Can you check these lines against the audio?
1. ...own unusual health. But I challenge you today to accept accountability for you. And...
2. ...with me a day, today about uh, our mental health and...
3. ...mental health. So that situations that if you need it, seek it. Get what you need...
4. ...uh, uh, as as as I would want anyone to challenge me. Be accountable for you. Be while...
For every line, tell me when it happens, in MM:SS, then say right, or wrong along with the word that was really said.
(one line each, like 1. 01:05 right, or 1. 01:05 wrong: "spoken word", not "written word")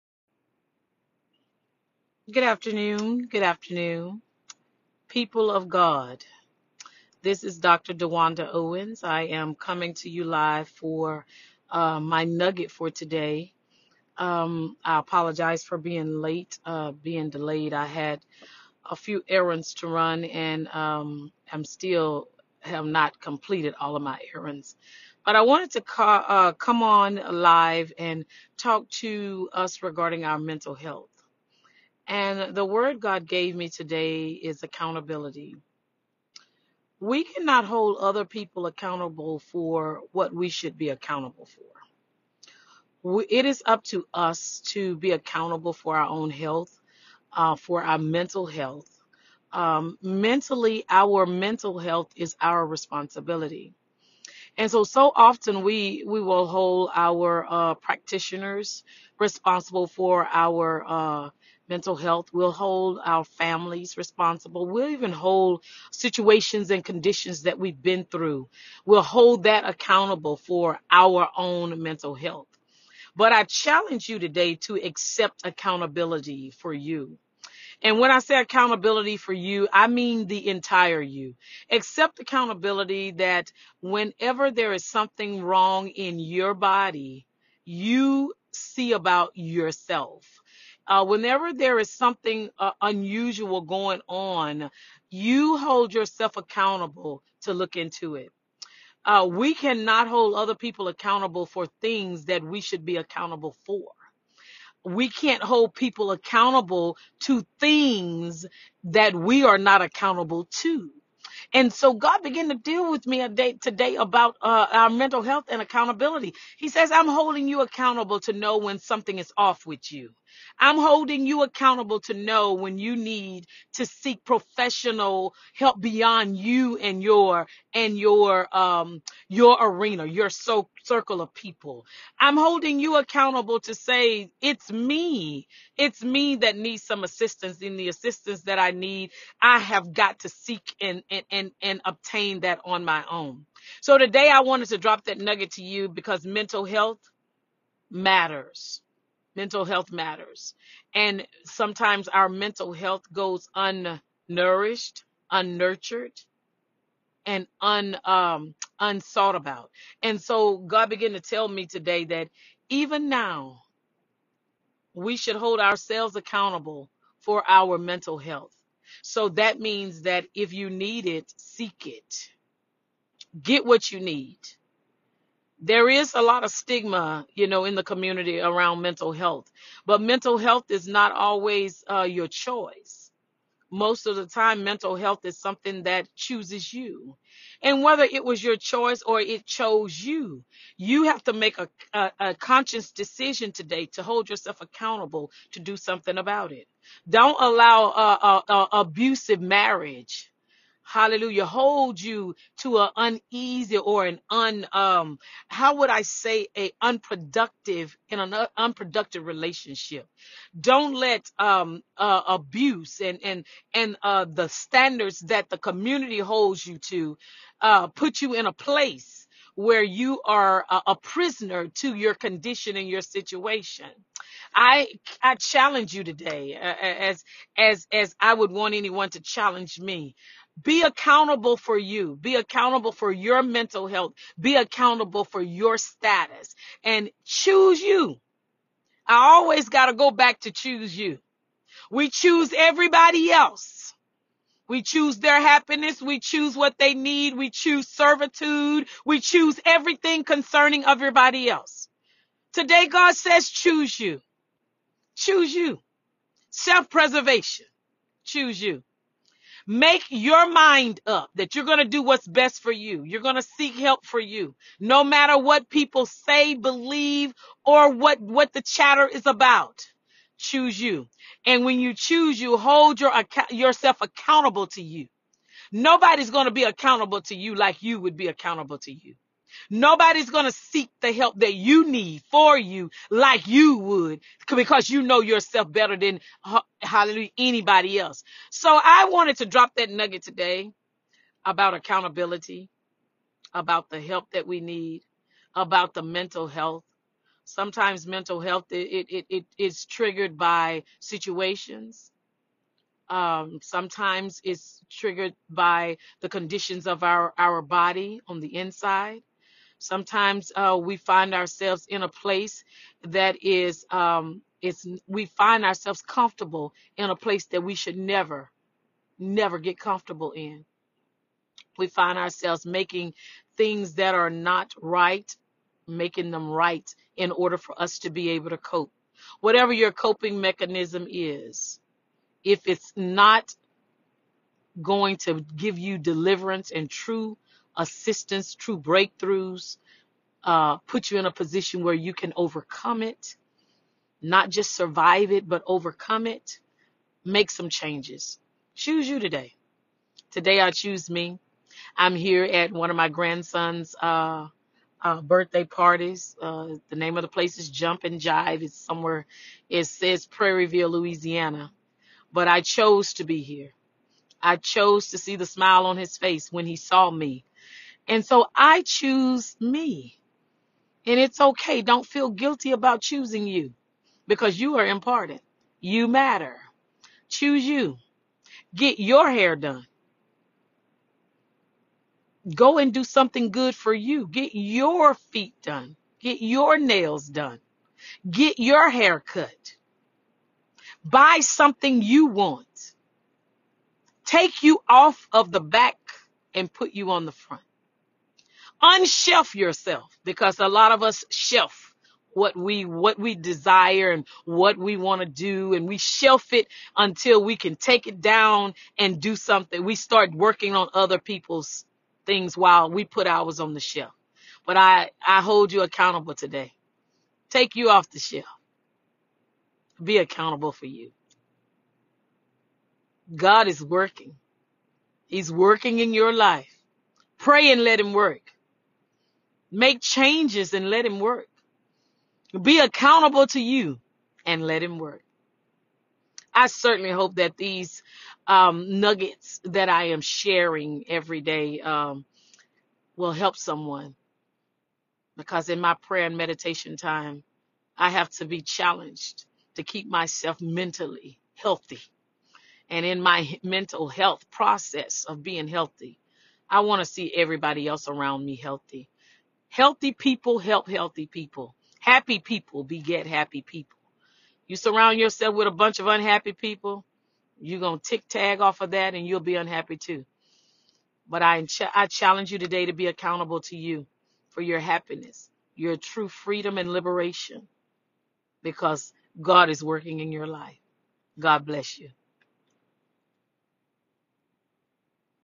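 1. 01:11 wrong: "mental", not "unusual"
2. 01:52 right
3. 02:47 wrong: "means", not "situations"
4. 03:46 wrong: "accountable", not "while".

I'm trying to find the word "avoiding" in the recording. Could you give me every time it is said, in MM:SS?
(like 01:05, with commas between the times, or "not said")
not said.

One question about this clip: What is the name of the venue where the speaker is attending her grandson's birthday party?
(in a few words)
Jump and Jive.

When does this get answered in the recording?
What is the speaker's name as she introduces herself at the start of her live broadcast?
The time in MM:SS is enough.
00:07.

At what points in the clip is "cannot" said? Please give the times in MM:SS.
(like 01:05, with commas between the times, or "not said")
00:37, 01:39.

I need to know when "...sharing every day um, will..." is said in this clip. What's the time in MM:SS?
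07:20.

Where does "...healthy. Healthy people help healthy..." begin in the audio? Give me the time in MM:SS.
07:38.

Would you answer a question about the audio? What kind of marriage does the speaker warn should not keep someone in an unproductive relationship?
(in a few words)
abusive marriage.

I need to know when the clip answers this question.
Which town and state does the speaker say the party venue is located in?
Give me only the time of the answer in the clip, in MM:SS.
06:00.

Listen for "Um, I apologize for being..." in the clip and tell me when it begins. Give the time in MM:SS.
00:14.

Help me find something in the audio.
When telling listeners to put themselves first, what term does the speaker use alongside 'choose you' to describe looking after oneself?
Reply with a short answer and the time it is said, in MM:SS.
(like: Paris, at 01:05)
Self-preservation, at 04:16.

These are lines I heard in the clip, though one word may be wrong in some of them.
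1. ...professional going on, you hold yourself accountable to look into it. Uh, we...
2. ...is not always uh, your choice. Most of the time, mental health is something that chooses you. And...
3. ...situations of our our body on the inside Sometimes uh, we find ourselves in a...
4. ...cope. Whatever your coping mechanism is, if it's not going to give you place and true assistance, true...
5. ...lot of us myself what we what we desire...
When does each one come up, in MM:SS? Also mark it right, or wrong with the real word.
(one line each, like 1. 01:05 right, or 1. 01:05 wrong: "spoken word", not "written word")
1. 01:32 wrong: "unusual", not "professional"
2. 03:00 right
3. 05:06 wrong: "conditions", not "situations"
4. 05:28 wrong: "deliverance", not "place"
5. 06:40 wrong: "shelf", not "myself".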